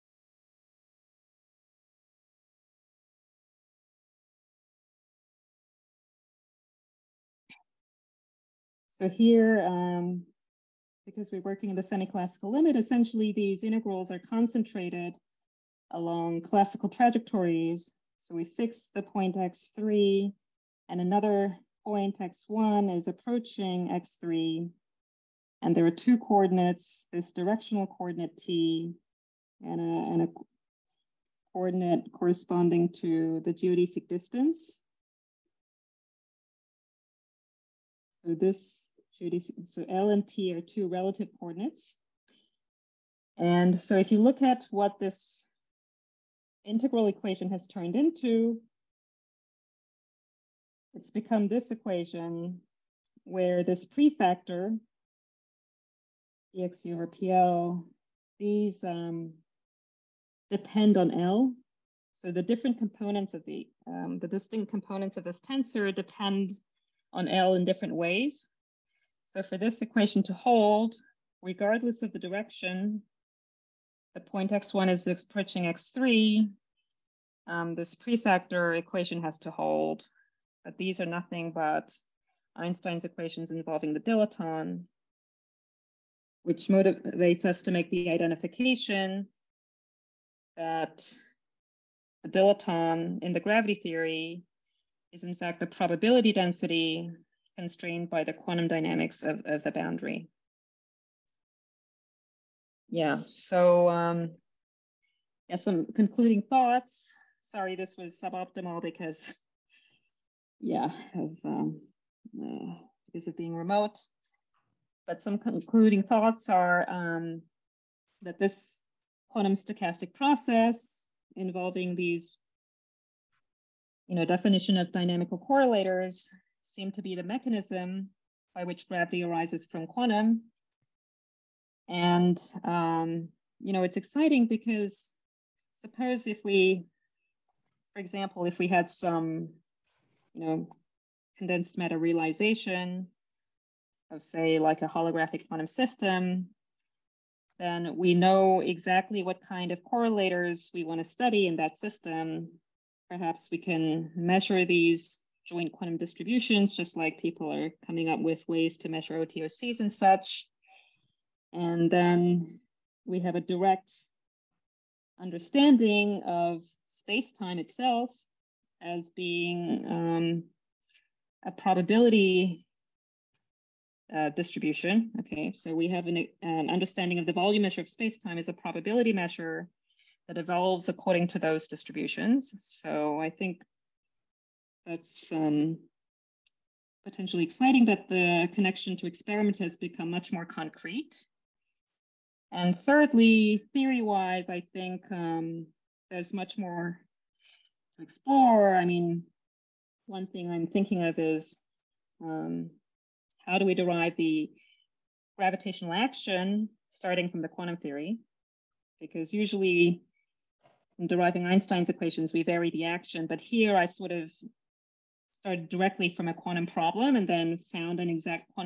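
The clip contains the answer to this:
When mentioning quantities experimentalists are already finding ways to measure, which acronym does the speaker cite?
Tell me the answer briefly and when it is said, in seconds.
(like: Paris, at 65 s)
OTOCs, at 159 s.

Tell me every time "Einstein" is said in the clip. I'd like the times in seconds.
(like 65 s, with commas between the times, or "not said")
82 s, 211 s.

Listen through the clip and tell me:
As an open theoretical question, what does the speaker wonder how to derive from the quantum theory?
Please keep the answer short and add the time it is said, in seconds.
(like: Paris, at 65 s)
gravitational action, at 205 s.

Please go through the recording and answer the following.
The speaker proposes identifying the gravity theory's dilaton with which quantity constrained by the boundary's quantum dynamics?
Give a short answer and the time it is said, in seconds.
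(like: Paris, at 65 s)
probability density, at 95 s.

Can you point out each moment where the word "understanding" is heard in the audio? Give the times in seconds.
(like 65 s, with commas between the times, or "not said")
165 s, 176 s.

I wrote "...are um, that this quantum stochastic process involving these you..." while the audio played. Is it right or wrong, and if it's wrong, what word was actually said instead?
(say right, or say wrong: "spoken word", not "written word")
right.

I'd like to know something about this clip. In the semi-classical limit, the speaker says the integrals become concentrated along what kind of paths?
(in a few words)
classical trajectories.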